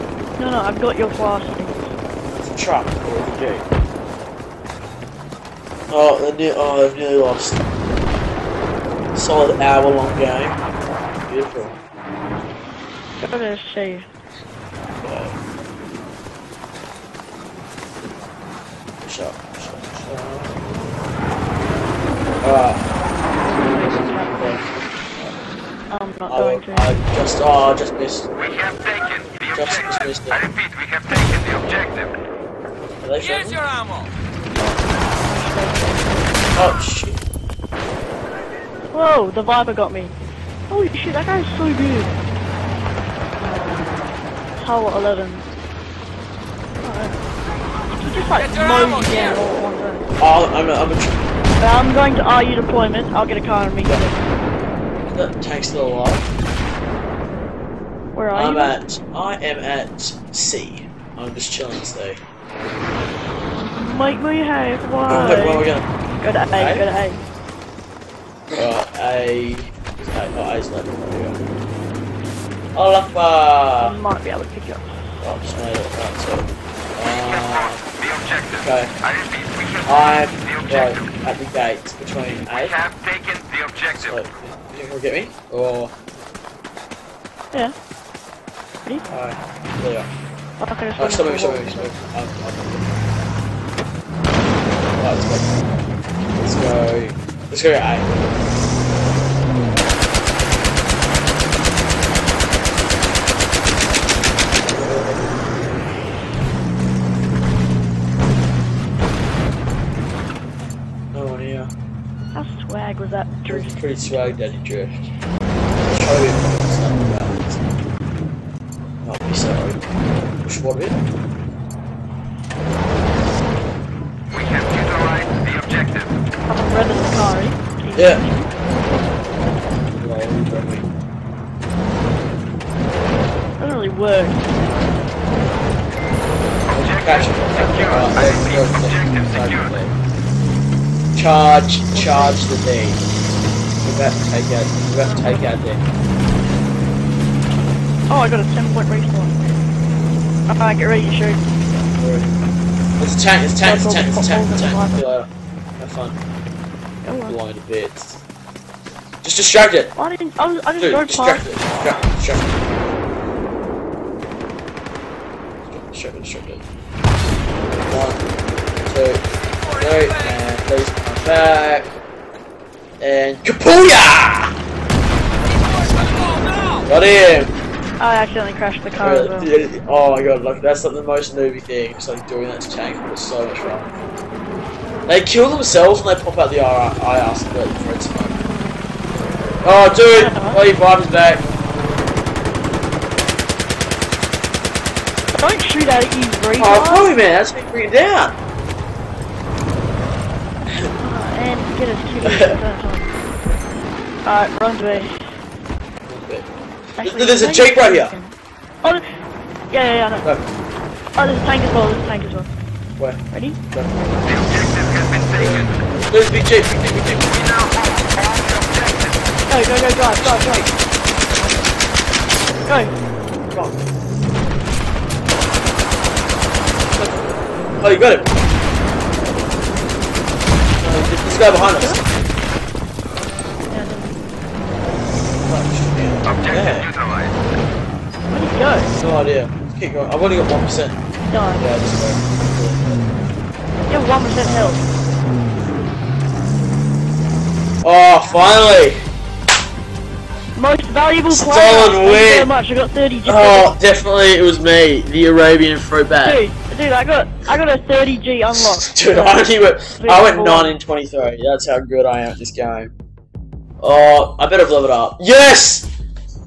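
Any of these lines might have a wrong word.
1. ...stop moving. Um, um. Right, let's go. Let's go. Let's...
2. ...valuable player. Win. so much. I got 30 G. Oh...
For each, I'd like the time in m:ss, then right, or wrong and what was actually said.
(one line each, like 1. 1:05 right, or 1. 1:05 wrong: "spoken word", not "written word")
1. 1:31 right
2. 4:10 right.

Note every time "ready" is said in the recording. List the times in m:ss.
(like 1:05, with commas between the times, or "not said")
2:30, 3:33.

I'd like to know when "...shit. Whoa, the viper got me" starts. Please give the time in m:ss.
0:36.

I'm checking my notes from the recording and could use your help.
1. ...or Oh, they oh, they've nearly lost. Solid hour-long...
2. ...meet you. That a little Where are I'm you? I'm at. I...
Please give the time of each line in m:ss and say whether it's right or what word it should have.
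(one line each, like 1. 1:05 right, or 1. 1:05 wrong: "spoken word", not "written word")
1. 0:02 right
2. 0:53 right.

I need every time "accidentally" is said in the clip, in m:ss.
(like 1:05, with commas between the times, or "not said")
2:58.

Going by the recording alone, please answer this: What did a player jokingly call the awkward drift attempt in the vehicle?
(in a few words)
swag daddy drift.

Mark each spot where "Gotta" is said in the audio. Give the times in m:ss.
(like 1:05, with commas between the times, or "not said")
0:13.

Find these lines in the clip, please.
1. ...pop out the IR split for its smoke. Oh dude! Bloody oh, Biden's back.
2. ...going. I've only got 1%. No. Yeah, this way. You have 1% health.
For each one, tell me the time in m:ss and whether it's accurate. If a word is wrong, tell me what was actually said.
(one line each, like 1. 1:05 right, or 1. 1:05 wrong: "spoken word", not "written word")
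1. 3:06 right
2. 3:59 right.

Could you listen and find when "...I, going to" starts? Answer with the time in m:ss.
0:26.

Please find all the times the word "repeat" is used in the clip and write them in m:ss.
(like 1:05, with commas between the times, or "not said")
0:30.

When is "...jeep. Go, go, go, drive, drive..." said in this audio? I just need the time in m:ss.
3:37.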